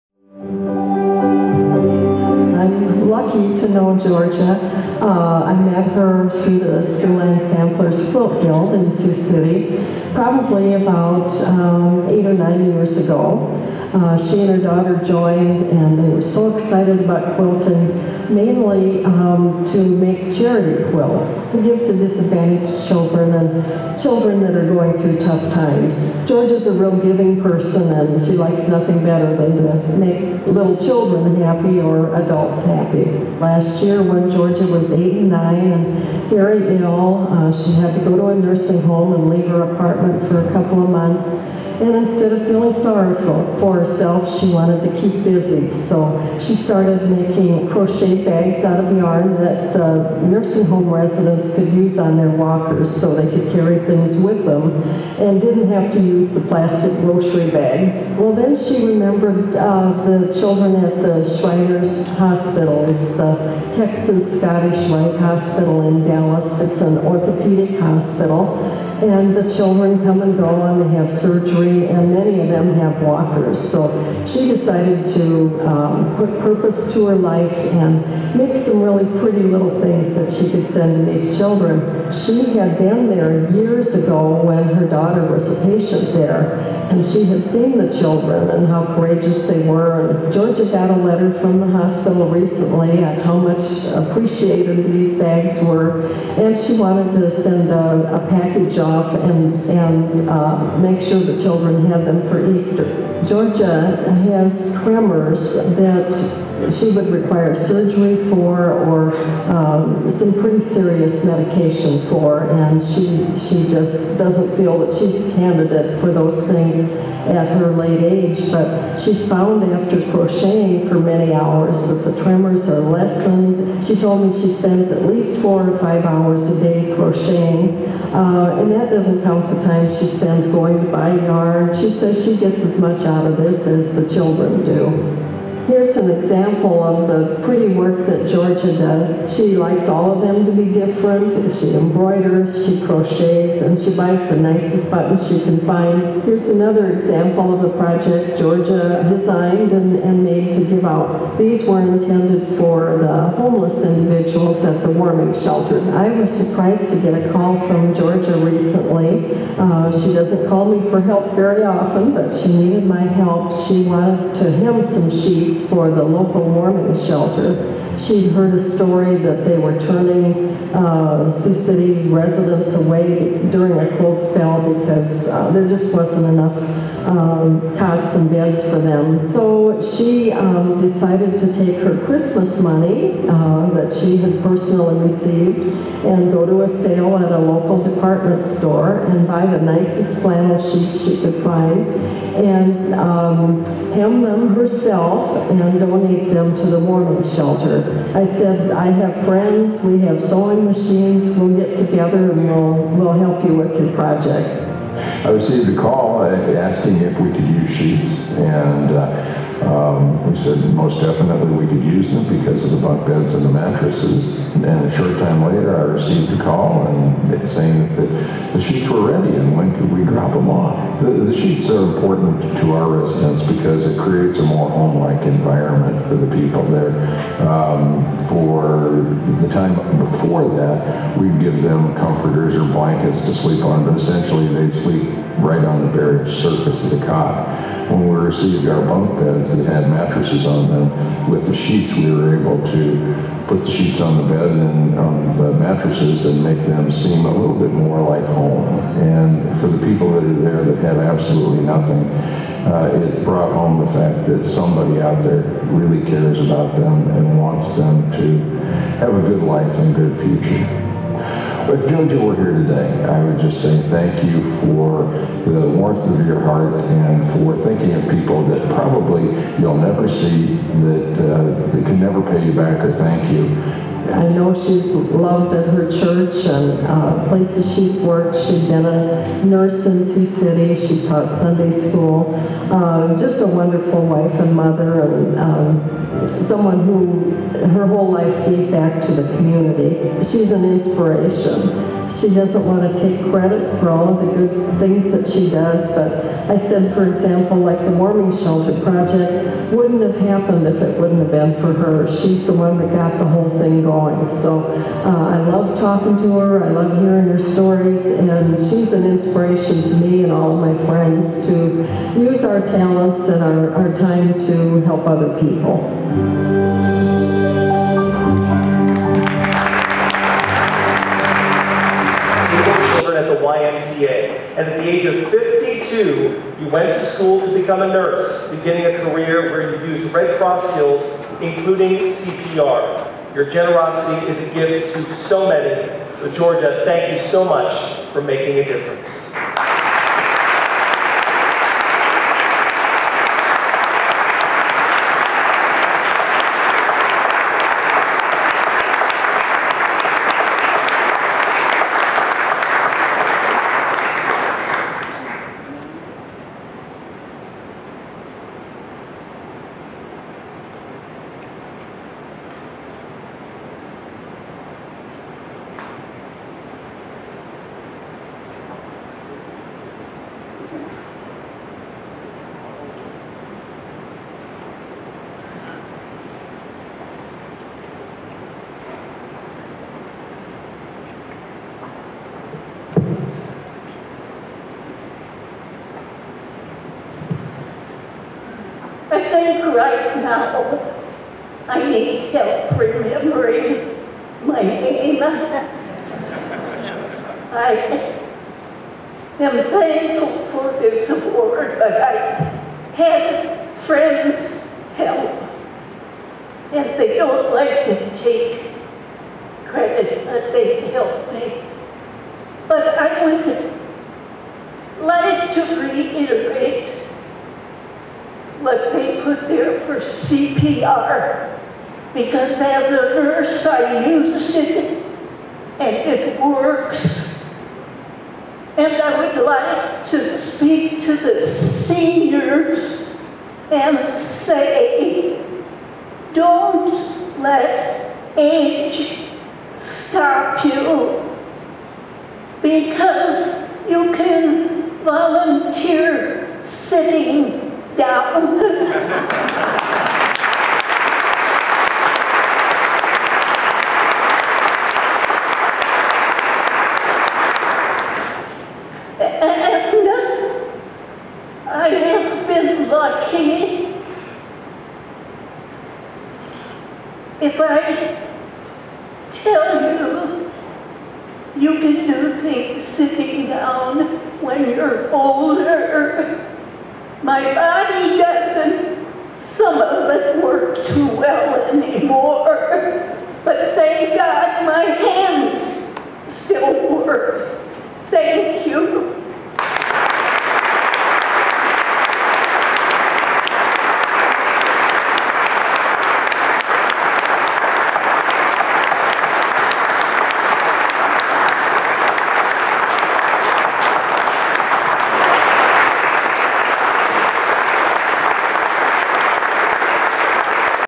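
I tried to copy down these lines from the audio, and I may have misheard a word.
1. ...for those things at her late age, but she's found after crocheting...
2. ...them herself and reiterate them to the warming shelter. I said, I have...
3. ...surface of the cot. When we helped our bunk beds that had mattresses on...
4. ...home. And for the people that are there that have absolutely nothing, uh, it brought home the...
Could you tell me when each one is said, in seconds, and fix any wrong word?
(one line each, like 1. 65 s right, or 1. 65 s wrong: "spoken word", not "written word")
1. 115 s right
2. 194 s wrong: "donate", not "reiterate"
3. 236 s wrong: "received", not "helped"
4. 248 s right.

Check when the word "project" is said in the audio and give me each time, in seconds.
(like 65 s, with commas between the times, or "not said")
147 s, 203 s, 298 s.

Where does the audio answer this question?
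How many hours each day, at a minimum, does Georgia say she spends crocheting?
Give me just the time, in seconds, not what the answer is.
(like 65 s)
125 s.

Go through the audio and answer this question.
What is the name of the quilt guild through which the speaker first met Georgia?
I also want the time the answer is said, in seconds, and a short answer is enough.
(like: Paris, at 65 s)
Siouxland Samplers Quilt Guild, at 6 s.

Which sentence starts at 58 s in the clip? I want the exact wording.
Well, then she remembered uh, the children at the Shriners Hospital.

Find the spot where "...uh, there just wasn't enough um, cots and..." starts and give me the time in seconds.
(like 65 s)
175 s.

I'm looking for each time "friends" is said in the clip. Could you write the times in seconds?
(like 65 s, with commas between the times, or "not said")
199 s, 310 s, 403 s.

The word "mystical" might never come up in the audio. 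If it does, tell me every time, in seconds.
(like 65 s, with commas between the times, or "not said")
not said.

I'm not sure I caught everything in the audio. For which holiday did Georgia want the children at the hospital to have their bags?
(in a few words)
Easter.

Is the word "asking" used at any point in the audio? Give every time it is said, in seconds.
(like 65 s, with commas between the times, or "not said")
206 s.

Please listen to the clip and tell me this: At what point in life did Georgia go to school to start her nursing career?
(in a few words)
Age 52.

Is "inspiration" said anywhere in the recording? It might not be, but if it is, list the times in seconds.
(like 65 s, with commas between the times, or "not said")
290 s, 309 s.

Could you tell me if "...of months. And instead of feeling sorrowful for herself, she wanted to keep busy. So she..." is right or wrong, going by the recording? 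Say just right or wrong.
right.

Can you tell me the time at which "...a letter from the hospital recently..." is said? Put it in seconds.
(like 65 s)
90 s.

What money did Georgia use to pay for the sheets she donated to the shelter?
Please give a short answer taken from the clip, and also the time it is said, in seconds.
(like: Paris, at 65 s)
Christmas money, at 182 s.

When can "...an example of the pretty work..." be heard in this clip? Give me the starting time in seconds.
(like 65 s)
135 s.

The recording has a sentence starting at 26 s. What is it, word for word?
George is a real giving person, and she likes nothing better than to make little children happy or adults happy.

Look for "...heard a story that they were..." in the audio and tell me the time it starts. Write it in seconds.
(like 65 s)
168 s.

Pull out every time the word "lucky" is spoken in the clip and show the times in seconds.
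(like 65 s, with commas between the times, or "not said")
3 s, 462 s.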